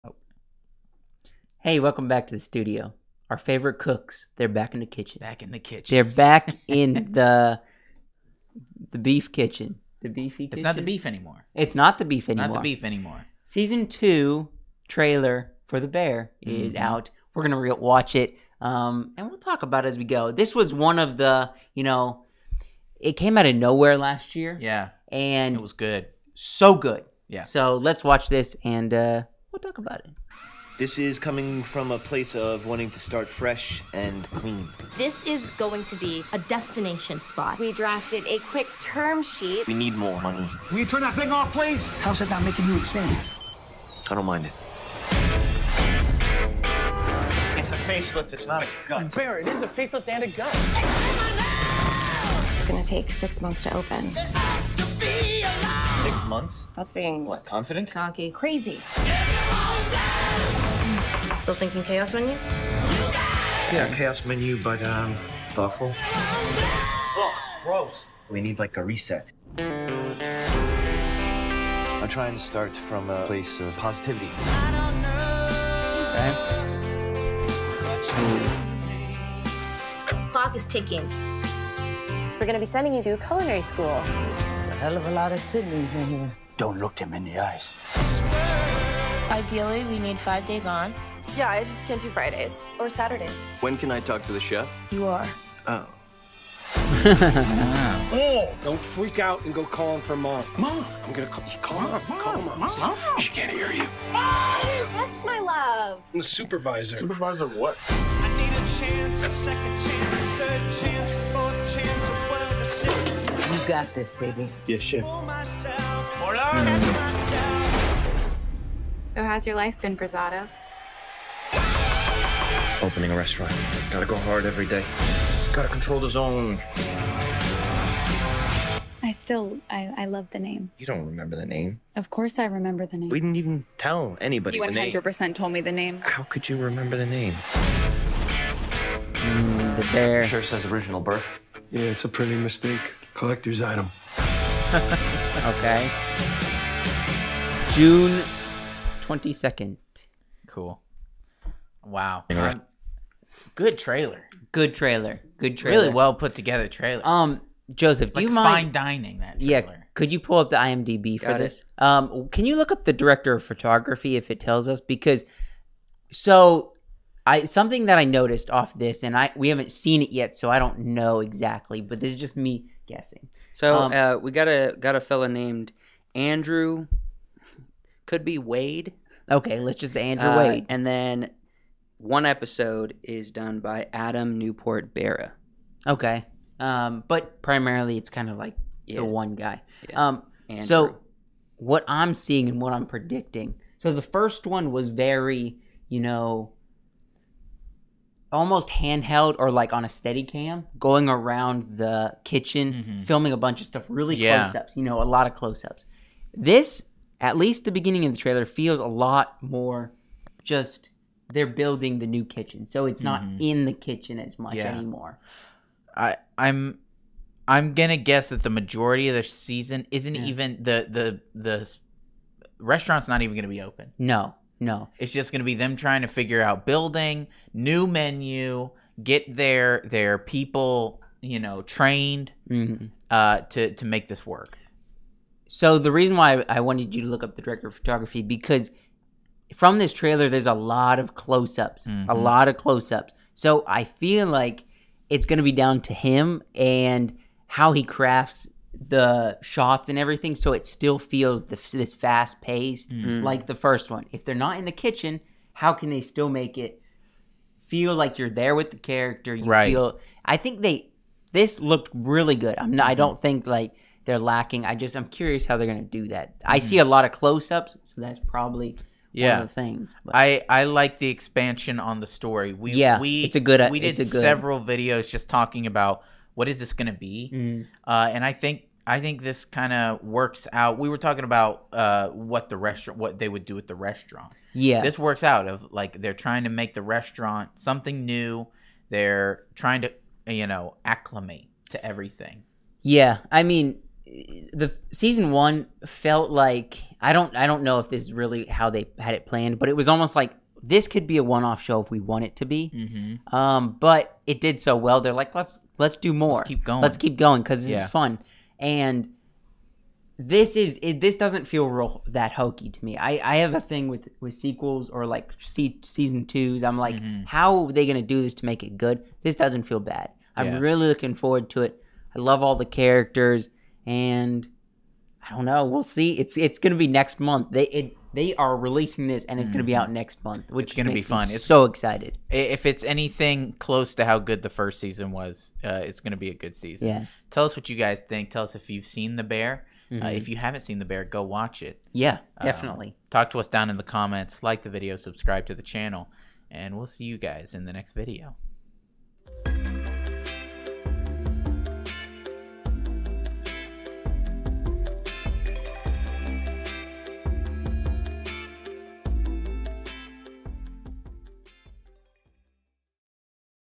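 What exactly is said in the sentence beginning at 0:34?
This is going to be a destination spot.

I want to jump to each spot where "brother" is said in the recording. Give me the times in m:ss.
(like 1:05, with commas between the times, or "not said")
not said.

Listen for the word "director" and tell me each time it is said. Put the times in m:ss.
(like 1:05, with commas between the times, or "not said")
2:42, 3:57.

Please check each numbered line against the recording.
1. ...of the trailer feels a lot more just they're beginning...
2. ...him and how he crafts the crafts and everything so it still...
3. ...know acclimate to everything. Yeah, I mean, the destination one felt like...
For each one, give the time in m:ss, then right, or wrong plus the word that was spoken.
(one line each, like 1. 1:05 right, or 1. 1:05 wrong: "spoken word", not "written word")
1. 3:28 wrong: "building", not "beginning"
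2. 4:05 wrong: "shots", not "crafts"
3. 4:50 wrong: "season", not "destination".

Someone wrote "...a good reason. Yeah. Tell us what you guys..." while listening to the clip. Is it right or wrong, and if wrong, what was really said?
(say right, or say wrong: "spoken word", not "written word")
wrong: "season", not "reason".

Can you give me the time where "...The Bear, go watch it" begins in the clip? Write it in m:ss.
5:40.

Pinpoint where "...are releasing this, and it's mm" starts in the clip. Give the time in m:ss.
5:28.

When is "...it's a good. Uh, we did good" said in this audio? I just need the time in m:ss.
4:33.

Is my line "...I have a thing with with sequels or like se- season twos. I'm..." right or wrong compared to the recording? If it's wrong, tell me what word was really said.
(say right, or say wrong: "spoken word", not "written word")
right.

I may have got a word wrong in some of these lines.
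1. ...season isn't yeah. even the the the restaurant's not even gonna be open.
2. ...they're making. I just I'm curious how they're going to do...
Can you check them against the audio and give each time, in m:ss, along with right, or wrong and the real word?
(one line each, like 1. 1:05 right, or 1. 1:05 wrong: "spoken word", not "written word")
1. 3:39 right
2. 4:24 wrong: "lacking", not "making".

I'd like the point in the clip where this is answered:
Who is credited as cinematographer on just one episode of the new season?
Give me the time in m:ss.
3:03.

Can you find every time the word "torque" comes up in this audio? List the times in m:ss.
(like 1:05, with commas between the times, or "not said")
not said.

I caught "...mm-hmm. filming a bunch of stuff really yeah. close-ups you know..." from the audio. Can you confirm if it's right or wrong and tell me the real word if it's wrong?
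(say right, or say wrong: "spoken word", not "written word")
right.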